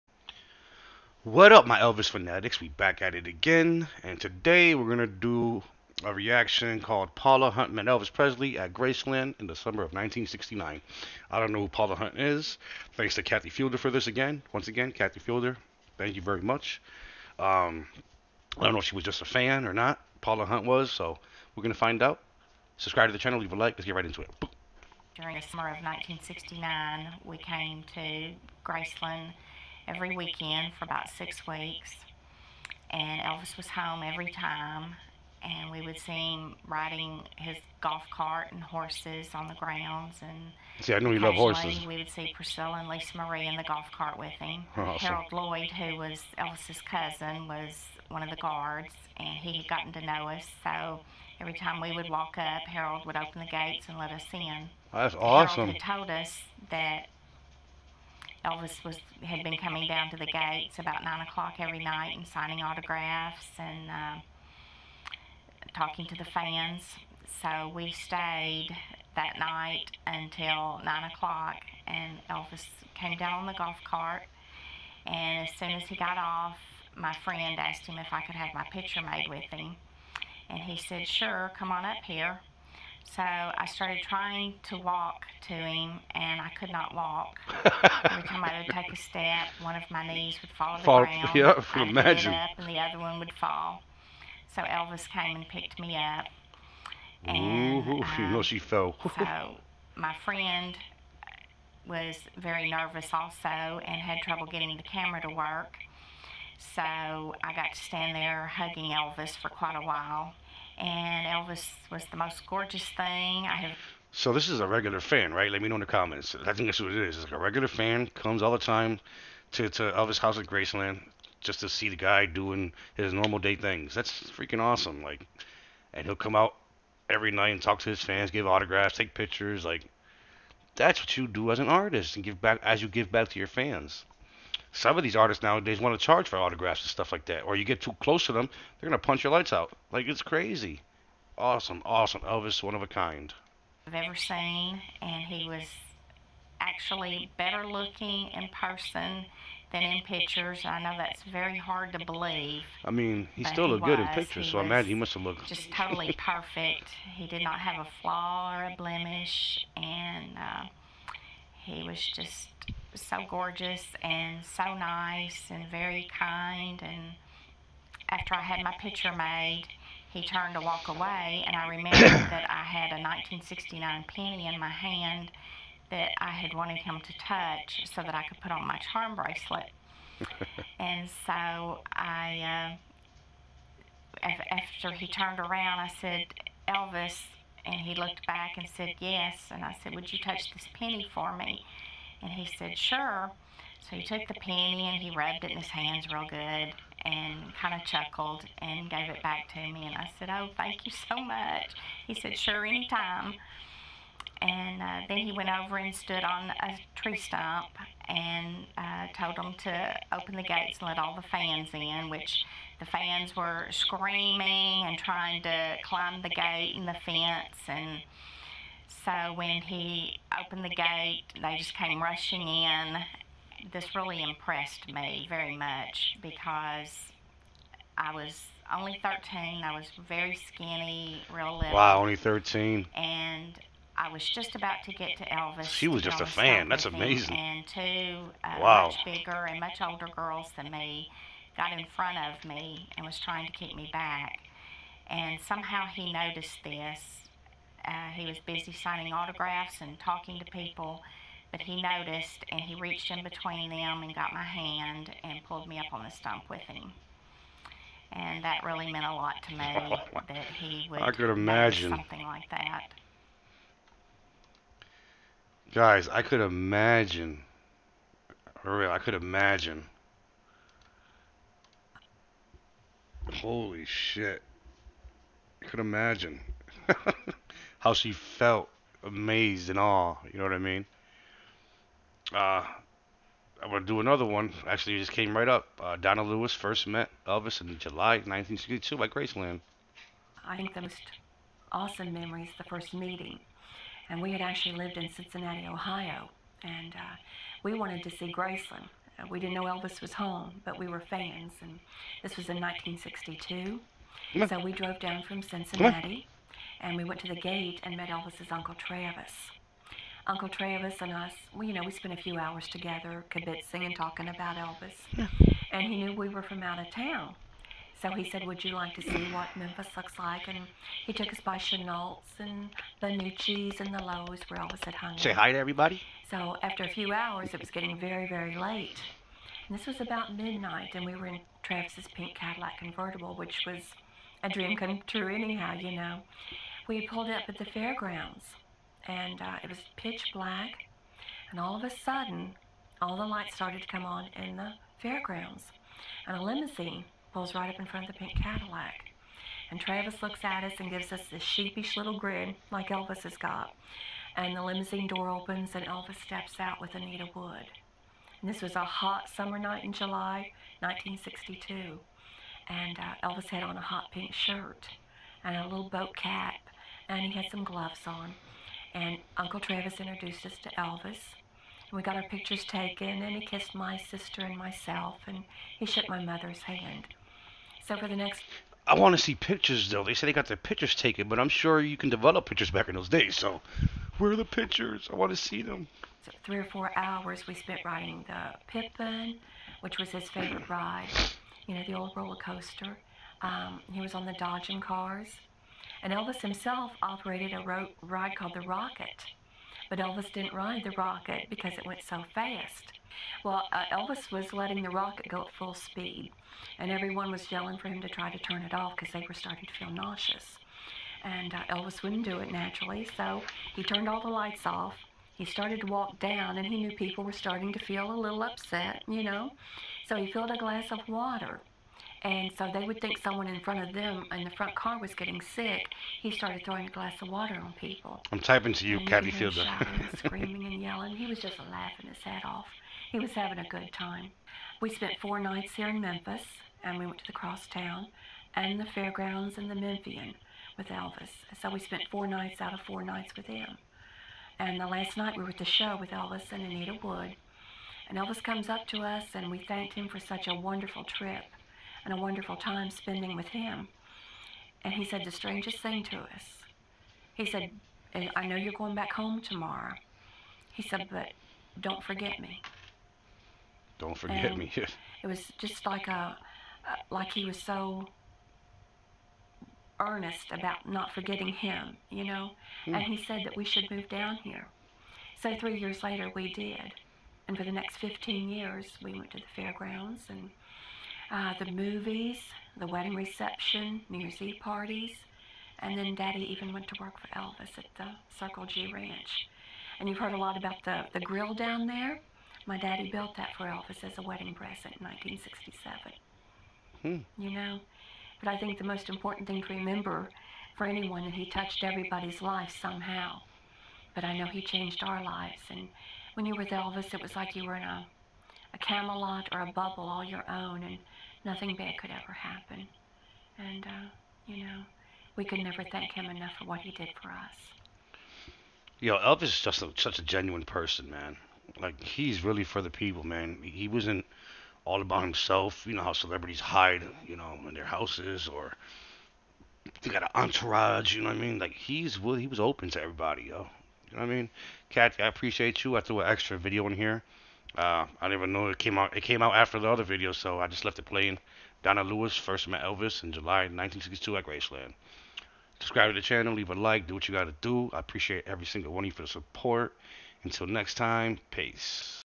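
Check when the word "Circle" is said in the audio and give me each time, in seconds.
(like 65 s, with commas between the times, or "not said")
488 s.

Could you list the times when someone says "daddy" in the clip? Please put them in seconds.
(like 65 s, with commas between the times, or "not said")
486 s, 492 s.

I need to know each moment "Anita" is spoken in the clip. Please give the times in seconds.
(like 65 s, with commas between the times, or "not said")
356 s, 446 s.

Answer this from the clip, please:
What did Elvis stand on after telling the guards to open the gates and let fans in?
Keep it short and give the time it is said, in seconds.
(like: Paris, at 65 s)
A tree stump, at 206 s.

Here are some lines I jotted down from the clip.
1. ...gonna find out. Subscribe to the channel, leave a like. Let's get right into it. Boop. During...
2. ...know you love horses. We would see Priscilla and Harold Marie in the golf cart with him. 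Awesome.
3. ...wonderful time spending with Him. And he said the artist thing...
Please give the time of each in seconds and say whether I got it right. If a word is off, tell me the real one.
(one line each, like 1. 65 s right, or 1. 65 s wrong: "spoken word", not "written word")
1. 21 s right
2. 40 s wrong: "Lisa", not "Harold"
3. 452 s wrong: "strangest", not "artist".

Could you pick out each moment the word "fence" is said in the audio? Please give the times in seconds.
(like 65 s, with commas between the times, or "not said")
217 s.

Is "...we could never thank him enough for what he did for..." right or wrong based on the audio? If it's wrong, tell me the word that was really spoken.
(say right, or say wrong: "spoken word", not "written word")
right.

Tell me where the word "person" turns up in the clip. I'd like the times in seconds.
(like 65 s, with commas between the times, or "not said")
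148 s, 520 s.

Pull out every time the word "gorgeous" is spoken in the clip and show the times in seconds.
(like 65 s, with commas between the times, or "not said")
112 s, 163 s.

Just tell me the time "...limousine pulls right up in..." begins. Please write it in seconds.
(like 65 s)
346 s.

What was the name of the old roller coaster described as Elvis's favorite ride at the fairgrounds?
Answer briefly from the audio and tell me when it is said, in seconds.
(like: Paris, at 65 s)
The Pippin, at 388 s.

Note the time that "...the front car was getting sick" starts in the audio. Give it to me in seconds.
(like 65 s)
424 s.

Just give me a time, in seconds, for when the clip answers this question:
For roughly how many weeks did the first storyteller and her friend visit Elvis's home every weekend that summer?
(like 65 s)
31 s.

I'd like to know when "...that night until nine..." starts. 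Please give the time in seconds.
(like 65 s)
69 s.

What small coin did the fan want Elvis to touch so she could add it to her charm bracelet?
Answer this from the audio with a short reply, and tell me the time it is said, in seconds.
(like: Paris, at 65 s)
1969 penny, at 173 s.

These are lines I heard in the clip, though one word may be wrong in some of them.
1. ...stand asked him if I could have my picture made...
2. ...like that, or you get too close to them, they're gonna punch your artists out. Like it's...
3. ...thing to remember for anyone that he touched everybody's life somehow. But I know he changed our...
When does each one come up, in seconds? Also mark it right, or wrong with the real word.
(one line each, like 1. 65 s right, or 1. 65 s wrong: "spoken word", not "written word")
1. 77 s wrong: "friend", not "stand"
2. 137 s wrong: "lights", not "artists"
3. 499 s right.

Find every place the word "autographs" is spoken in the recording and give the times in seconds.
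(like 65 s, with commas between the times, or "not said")
62 s, 128 s, 136 s, 249 s.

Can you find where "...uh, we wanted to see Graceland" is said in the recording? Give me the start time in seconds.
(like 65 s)
296 s.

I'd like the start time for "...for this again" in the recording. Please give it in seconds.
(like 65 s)
13 s.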